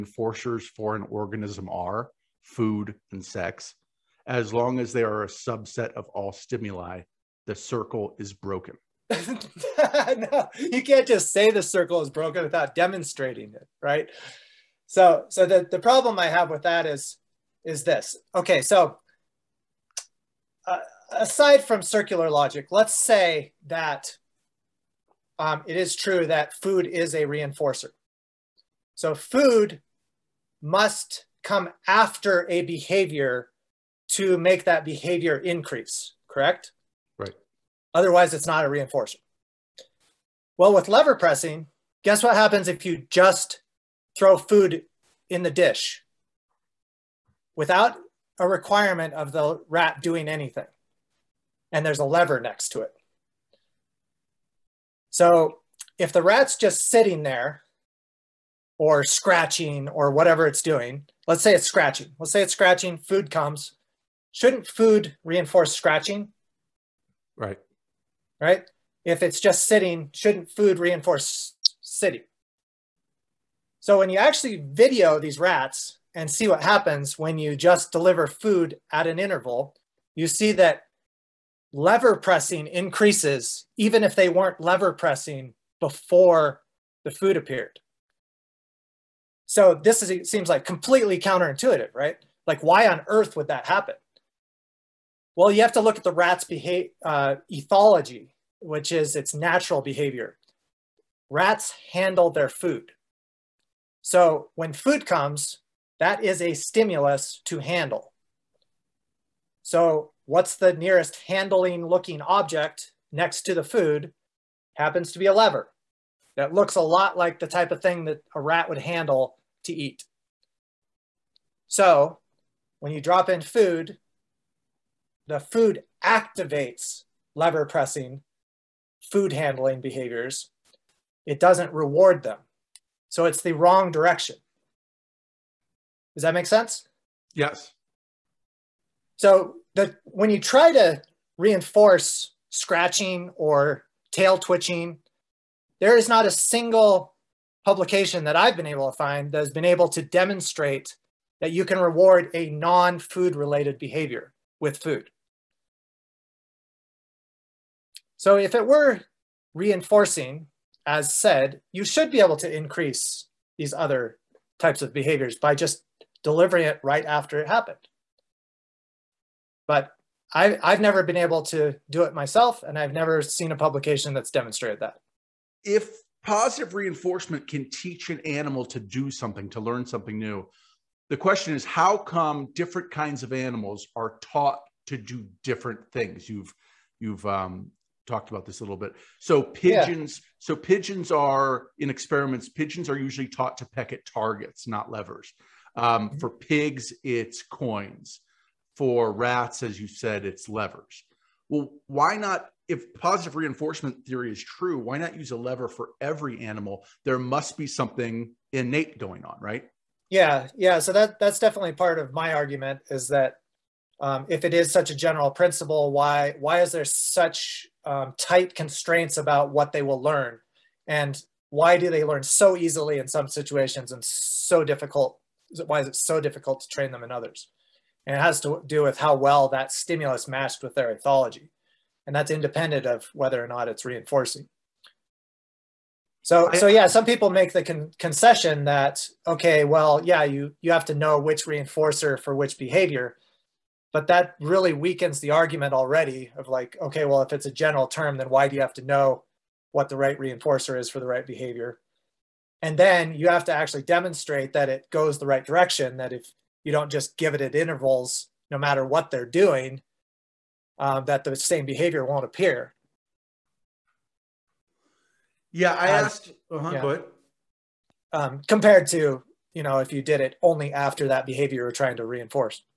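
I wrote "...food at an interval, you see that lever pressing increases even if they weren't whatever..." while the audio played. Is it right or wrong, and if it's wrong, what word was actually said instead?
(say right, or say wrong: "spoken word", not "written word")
wrong: "lever", not "whatever".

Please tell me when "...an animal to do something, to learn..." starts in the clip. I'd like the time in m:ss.
2:58.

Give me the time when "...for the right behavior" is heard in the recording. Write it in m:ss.
4:10.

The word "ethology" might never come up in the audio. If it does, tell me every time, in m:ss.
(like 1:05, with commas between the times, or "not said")
1:37, 3:50.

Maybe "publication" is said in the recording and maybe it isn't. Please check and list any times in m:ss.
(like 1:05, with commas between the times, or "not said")
2:27, 2:53.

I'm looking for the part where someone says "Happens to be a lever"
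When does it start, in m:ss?
1:54.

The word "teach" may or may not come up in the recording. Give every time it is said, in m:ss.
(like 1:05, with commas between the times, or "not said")
2:57.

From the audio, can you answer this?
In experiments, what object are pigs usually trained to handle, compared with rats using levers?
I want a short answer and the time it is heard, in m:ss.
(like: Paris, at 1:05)
Coins, at 3:17.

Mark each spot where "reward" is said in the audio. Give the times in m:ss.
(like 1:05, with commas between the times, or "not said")
2:11, 2:31.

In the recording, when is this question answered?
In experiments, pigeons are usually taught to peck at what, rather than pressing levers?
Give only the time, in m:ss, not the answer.
3:14.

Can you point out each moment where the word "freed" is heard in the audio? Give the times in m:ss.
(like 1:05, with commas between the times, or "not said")
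not said.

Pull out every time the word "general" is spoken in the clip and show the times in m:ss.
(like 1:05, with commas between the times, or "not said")
3:34, 4:07.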